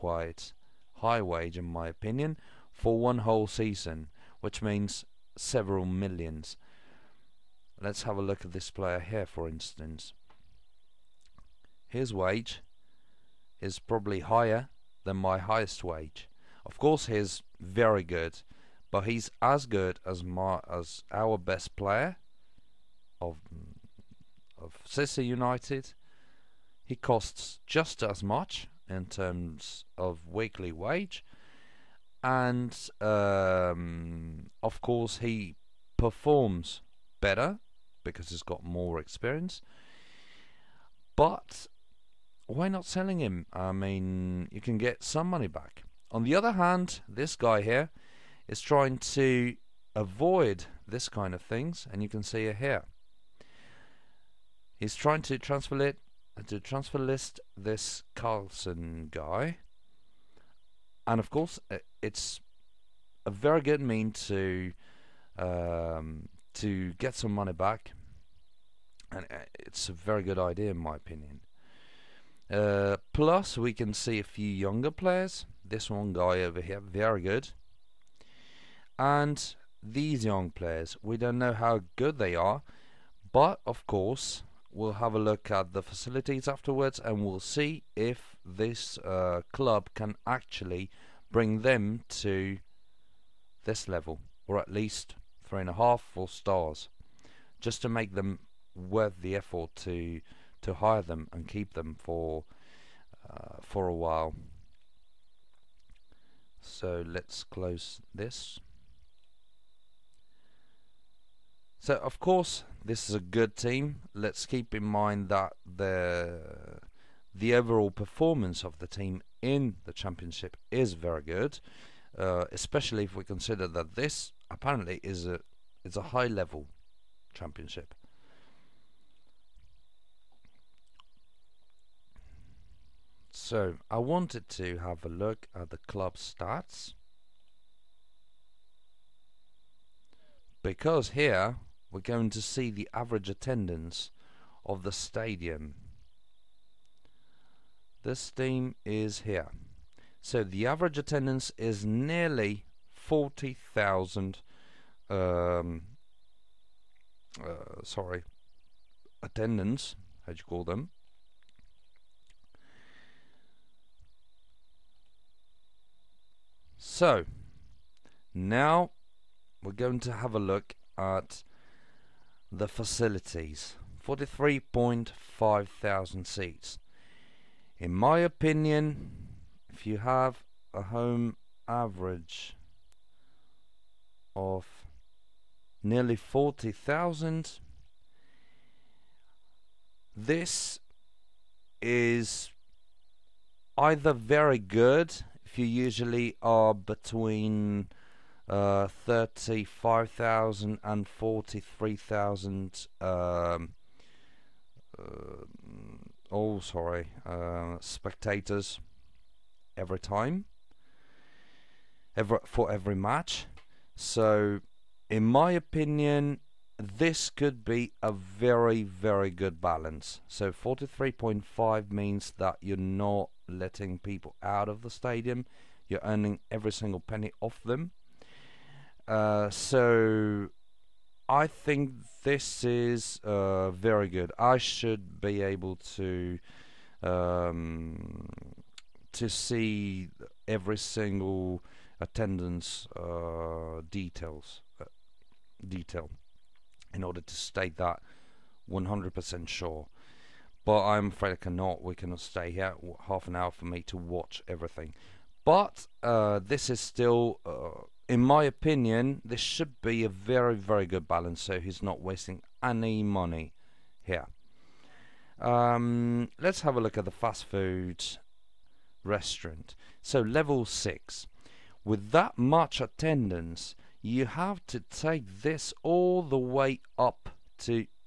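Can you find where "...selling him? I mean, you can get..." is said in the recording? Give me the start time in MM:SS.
00:42.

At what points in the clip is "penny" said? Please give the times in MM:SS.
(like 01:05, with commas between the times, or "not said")
03:47.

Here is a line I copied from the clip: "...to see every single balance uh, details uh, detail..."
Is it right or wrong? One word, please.
wrong.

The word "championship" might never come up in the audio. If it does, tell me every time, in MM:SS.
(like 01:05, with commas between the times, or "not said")
01:59, 02:07.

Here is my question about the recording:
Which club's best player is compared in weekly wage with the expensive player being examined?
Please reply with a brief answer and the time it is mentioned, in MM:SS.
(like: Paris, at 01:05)
Sicily United, at 00:24.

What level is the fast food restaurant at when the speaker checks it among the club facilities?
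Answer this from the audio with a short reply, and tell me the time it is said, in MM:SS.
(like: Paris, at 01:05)
6, at 04:30.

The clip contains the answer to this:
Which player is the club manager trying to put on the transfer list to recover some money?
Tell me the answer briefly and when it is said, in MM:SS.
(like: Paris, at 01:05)
Carlson, at 00:58.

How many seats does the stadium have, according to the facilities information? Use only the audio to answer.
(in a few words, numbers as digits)
43,500.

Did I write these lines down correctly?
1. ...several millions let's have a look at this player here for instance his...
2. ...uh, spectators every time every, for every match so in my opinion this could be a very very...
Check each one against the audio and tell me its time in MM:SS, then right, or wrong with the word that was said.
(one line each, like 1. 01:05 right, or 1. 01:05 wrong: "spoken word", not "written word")
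1. 00:05 right
2. 03:27 right.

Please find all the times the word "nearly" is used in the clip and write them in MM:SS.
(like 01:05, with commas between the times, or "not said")
02:31, 03:05.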